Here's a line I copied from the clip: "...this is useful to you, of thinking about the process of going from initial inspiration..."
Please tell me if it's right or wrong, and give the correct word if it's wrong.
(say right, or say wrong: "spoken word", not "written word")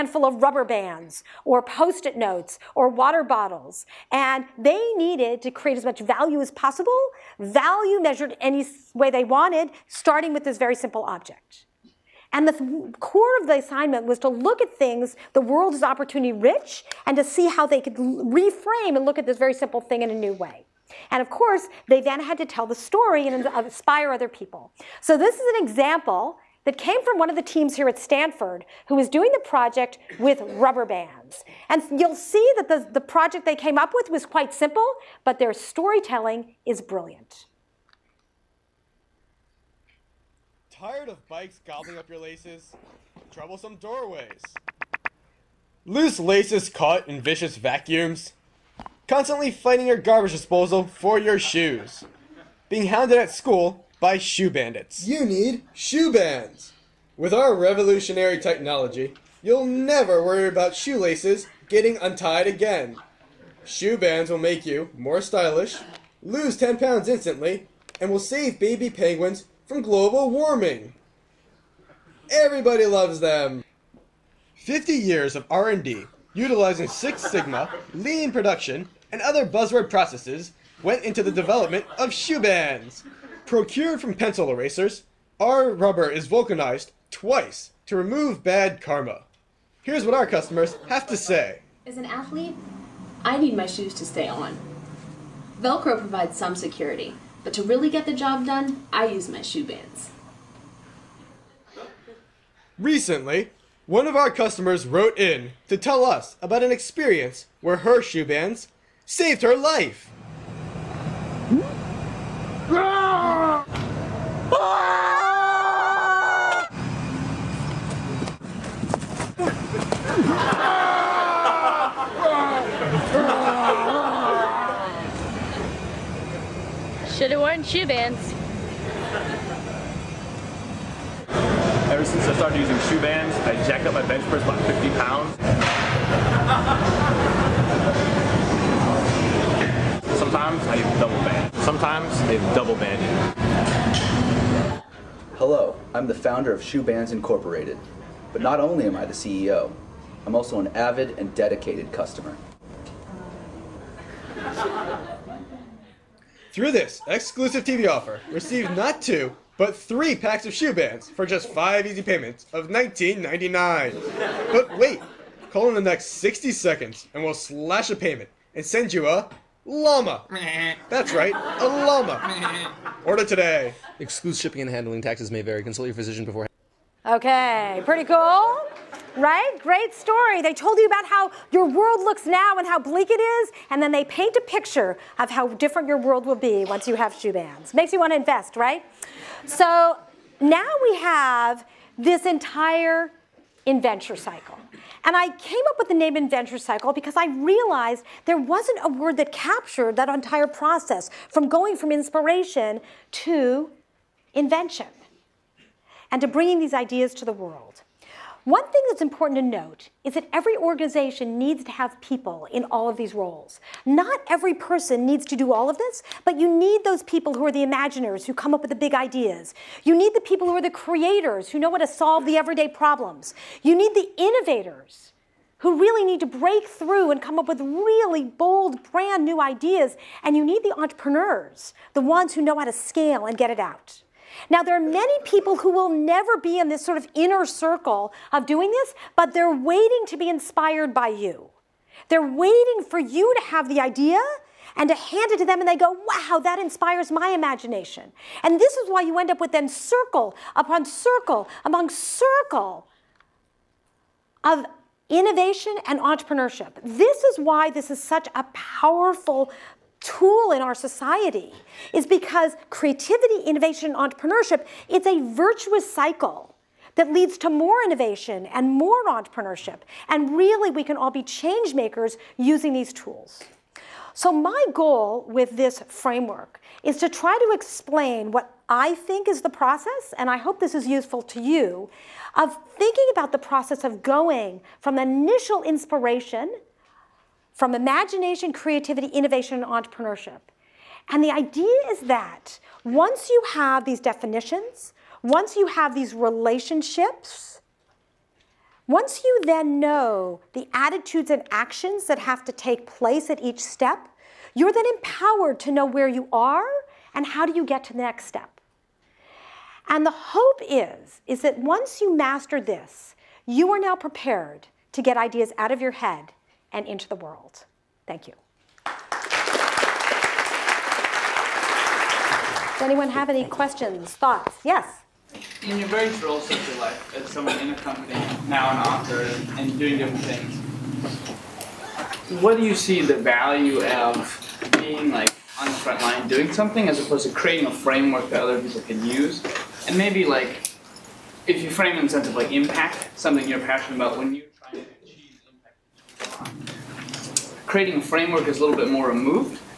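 right.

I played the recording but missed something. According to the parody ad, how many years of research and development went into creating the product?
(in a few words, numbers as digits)
50.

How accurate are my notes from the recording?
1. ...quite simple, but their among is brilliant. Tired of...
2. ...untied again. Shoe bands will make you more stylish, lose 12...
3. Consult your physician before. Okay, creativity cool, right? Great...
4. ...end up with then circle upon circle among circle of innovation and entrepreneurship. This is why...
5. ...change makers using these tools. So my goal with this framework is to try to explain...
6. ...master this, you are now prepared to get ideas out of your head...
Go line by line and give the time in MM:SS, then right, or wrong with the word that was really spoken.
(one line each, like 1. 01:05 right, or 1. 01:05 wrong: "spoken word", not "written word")
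1. 00:34 wrong: "storytelling", not "among"
2. 01:01 wrong: "10", not "12"
3. 02:55 wrong: "pretty", not "creativity"
4. 04:09 right
5. 04:31 right
6. 05:12 right.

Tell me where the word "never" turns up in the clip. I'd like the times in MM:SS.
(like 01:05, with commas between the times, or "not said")
00:59, 03:55.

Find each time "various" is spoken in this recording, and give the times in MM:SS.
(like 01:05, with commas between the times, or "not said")
05:25.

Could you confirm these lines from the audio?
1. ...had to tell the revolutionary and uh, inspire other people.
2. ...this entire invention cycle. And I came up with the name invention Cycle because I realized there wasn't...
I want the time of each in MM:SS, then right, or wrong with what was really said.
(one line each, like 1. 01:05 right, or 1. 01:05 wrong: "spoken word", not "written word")
1. 00:22 wrong: "story", not "revolutionary"
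2. 03:11 right.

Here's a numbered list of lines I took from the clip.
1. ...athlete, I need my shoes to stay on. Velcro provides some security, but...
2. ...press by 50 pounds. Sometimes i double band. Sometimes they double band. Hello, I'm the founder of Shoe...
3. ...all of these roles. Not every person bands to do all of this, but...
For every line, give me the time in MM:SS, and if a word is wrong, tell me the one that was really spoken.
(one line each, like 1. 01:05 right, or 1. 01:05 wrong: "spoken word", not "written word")
1. 01:32 right
2. 02:14 right
3. 03:32 wrong: "needs", not "bands".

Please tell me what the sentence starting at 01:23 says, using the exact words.
Procured from pencil erasers, our rubber is vulcanized twice to remove bad karma.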